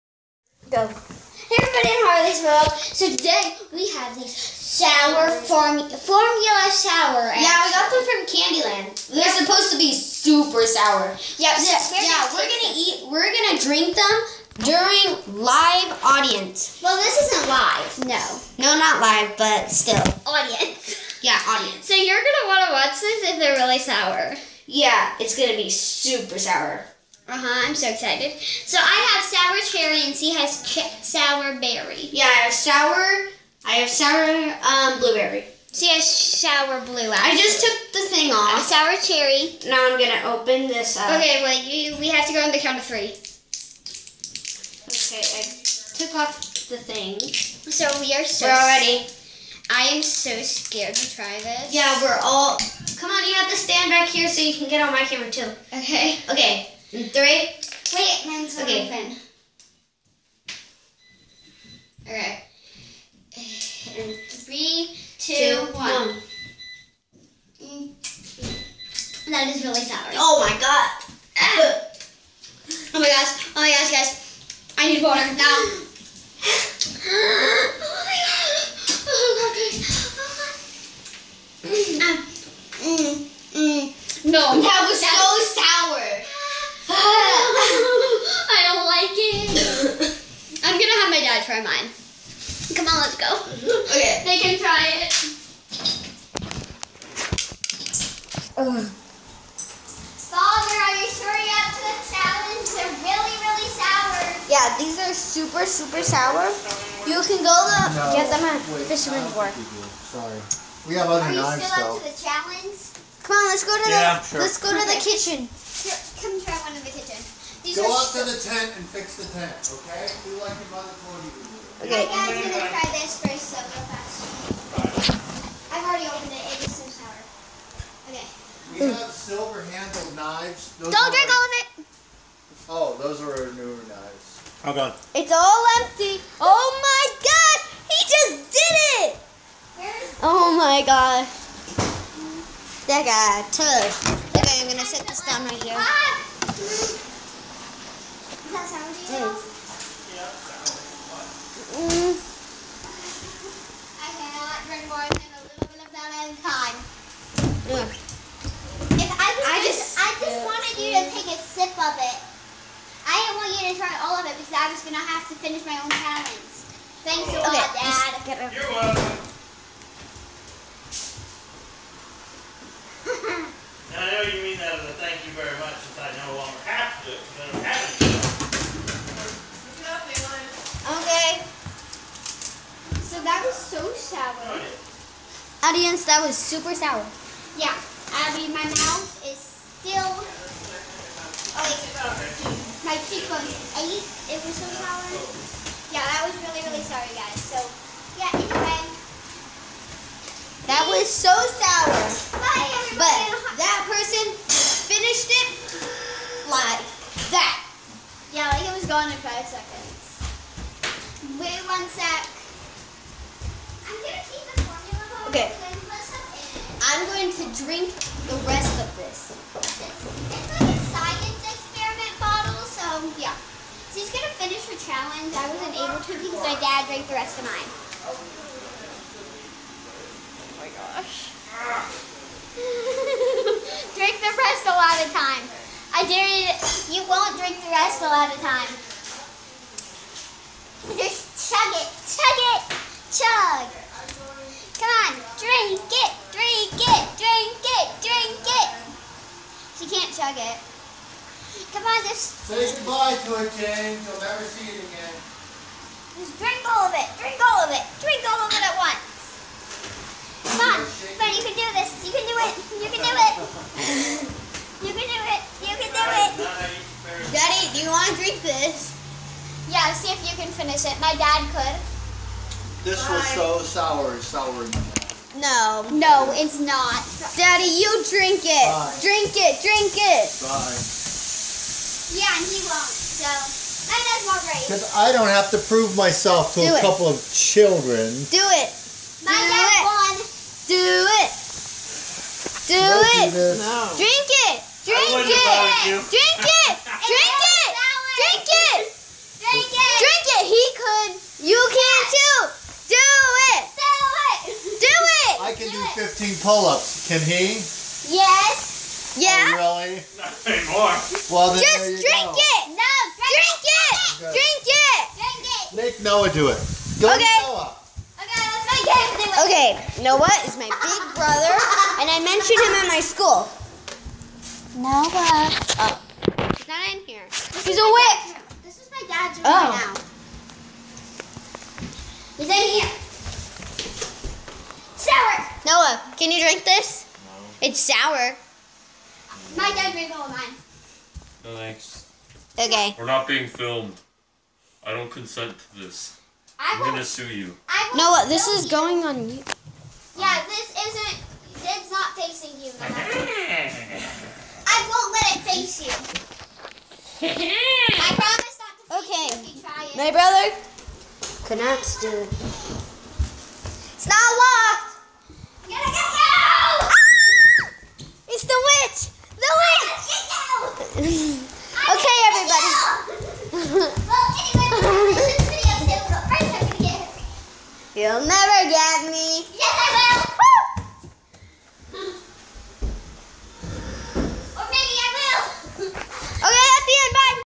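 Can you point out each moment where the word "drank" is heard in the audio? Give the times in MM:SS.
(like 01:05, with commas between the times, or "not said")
03:46.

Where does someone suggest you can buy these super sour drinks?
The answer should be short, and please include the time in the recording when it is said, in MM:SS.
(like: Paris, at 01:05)
Fisherman's Wharf, at 01:48.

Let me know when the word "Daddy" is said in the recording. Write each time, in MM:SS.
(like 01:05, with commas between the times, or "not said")
04:27, 04:37.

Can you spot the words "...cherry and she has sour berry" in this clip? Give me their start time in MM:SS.
00:29.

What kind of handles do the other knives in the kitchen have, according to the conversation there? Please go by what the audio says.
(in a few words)
silver.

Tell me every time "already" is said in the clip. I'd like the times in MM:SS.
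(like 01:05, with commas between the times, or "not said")
00:48, 02:05.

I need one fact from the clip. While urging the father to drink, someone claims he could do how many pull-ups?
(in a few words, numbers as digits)
15.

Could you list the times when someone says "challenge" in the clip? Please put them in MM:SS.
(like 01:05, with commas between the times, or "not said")
01:42, 01:52, 02:45, 03:44.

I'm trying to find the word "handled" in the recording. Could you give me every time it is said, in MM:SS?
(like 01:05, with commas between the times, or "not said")
02:09.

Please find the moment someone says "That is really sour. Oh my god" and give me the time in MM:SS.
01:09.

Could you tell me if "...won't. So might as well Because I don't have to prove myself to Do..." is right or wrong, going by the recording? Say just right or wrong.
right.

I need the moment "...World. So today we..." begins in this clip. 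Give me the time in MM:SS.
00:02.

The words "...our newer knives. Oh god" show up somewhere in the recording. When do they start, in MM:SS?
02:13.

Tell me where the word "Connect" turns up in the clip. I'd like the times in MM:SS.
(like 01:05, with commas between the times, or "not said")
06:01.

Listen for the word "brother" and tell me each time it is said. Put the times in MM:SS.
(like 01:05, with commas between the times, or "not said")
05:21, 06:00.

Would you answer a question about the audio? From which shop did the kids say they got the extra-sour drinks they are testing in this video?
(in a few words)
Candyland.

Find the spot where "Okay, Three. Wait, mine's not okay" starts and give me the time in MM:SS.
00:56.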